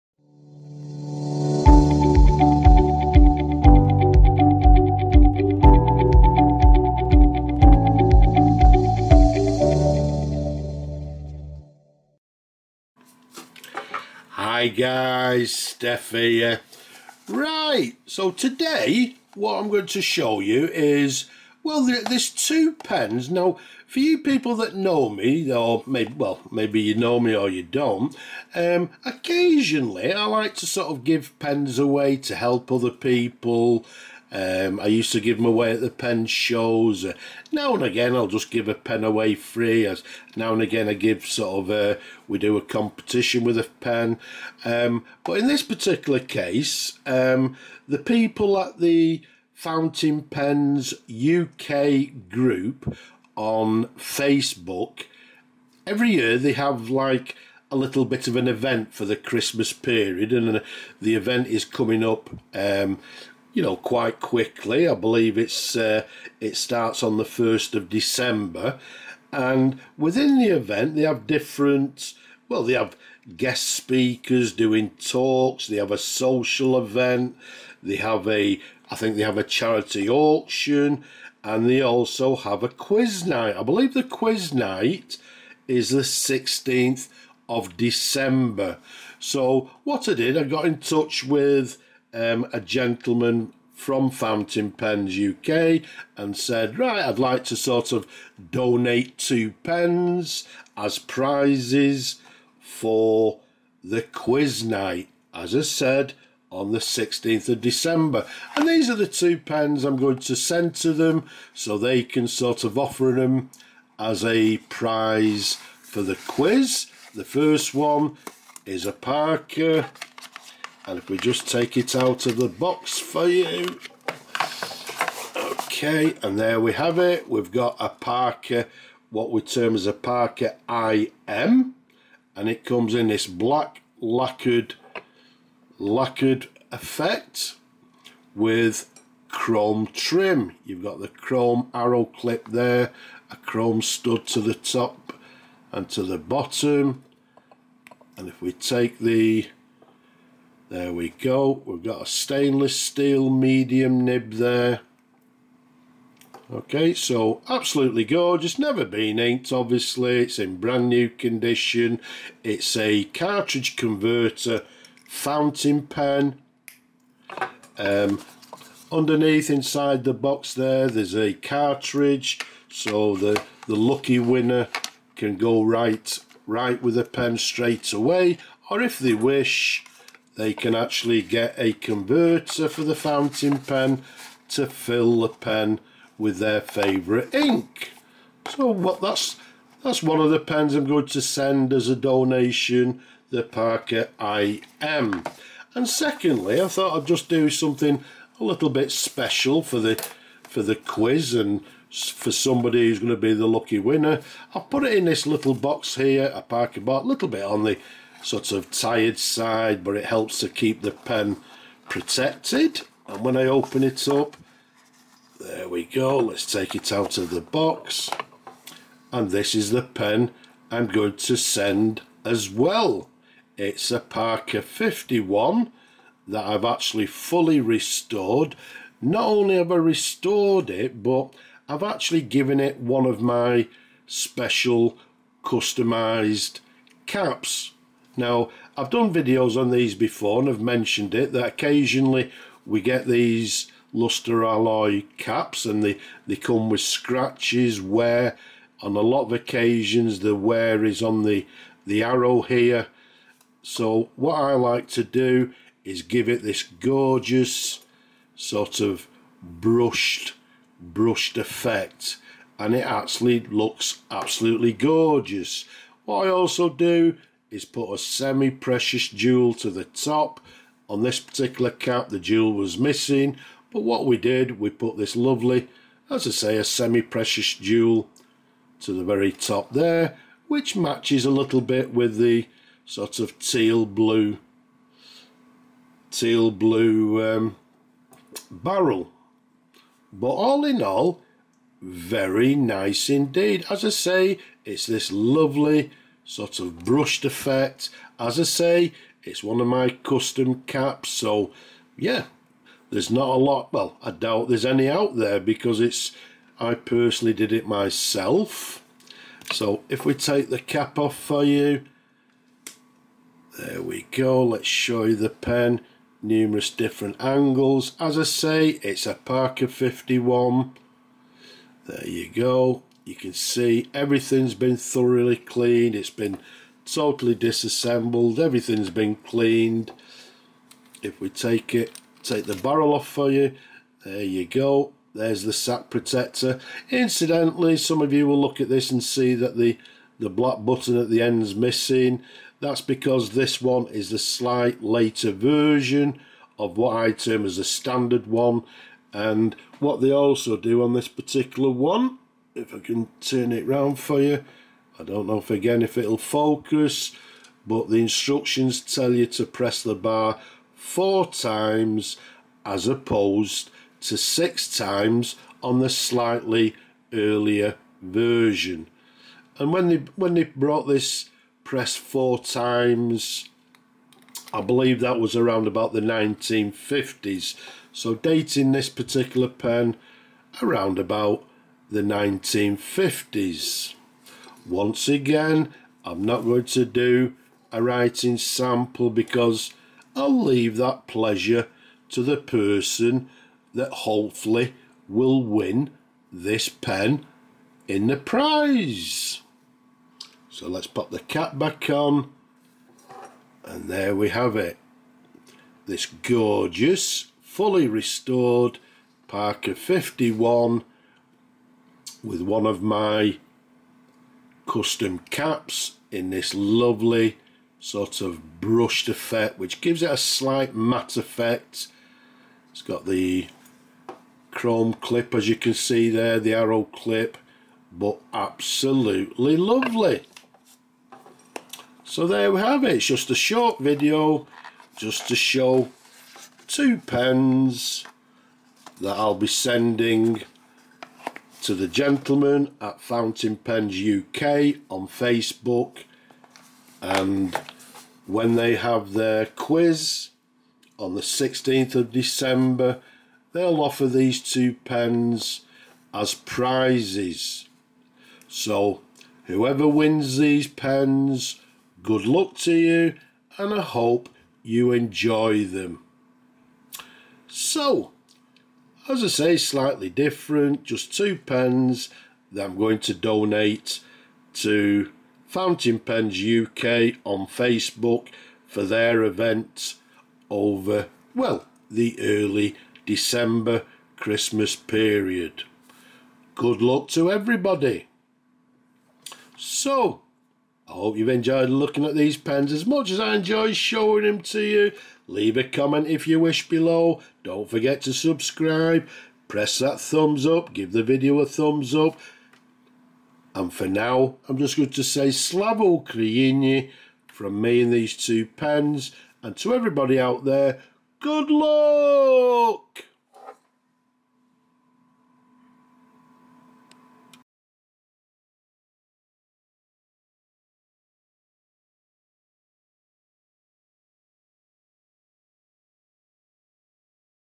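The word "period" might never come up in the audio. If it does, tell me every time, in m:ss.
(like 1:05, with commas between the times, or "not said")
0:59, 8:04.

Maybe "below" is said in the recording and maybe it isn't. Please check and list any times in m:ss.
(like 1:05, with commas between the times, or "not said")
8:16.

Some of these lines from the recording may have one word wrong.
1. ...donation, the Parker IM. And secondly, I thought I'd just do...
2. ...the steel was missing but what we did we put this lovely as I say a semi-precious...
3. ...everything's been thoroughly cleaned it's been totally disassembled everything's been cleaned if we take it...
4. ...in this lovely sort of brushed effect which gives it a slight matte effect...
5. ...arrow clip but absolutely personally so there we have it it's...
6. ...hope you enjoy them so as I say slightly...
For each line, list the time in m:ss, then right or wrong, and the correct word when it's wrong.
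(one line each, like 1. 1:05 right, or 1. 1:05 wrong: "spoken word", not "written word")
1. 3:11 right
2. 4:32 wrong: "jewel", not "steel"
3. 5:23 right
4. 6:56 right
5. 7:06 wrong: "lovely", not "personally"
6. 7:43 right.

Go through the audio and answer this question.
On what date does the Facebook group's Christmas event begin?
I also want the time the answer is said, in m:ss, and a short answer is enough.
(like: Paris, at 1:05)
1 December, at 1:07.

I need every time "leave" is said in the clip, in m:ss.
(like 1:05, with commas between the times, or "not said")
6:30, 8:15.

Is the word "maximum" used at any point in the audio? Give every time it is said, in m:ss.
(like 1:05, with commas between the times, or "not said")
not said.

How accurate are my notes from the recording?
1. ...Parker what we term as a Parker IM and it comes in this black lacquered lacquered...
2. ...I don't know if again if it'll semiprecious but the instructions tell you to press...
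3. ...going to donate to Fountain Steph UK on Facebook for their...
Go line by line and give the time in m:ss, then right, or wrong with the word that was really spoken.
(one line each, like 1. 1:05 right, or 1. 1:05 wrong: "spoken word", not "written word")
1. 2:07 right
2. 5:54 wrong: "focus", not "semiprecious"
3. 7:52 wrong: "Pens", not "Steph".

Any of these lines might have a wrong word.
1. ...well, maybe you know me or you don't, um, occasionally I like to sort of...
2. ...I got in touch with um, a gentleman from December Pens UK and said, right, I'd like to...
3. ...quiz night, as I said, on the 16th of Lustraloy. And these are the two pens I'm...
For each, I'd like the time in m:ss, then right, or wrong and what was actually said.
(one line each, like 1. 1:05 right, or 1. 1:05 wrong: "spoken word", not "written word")
1. 0:26 right
2. 1:30 wrong: "Fountain", not "December"
3. 1:44 wrong: "December", not "Lustraloy".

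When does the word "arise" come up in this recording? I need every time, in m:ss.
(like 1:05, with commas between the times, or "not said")
not said.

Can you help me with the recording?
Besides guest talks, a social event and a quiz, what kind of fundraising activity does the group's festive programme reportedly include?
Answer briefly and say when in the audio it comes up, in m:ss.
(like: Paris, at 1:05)
charity auction, at 1:19.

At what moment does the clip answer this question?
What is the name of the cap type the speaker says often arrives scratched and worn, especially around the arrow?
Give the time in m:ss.
4:03.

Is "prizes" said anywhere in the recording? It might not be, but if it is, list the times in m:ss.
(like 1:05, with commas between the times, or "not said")
1:40, 1:54, 6:38, 7:36.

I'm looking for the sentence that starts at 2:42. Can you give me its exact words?
It's a cartridge converter fountain pen.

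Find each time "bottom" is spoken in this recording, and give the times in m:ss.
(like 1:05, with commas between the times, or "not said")
2:26.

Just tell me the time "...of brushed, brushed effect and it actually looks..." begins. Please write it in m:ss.
4:18.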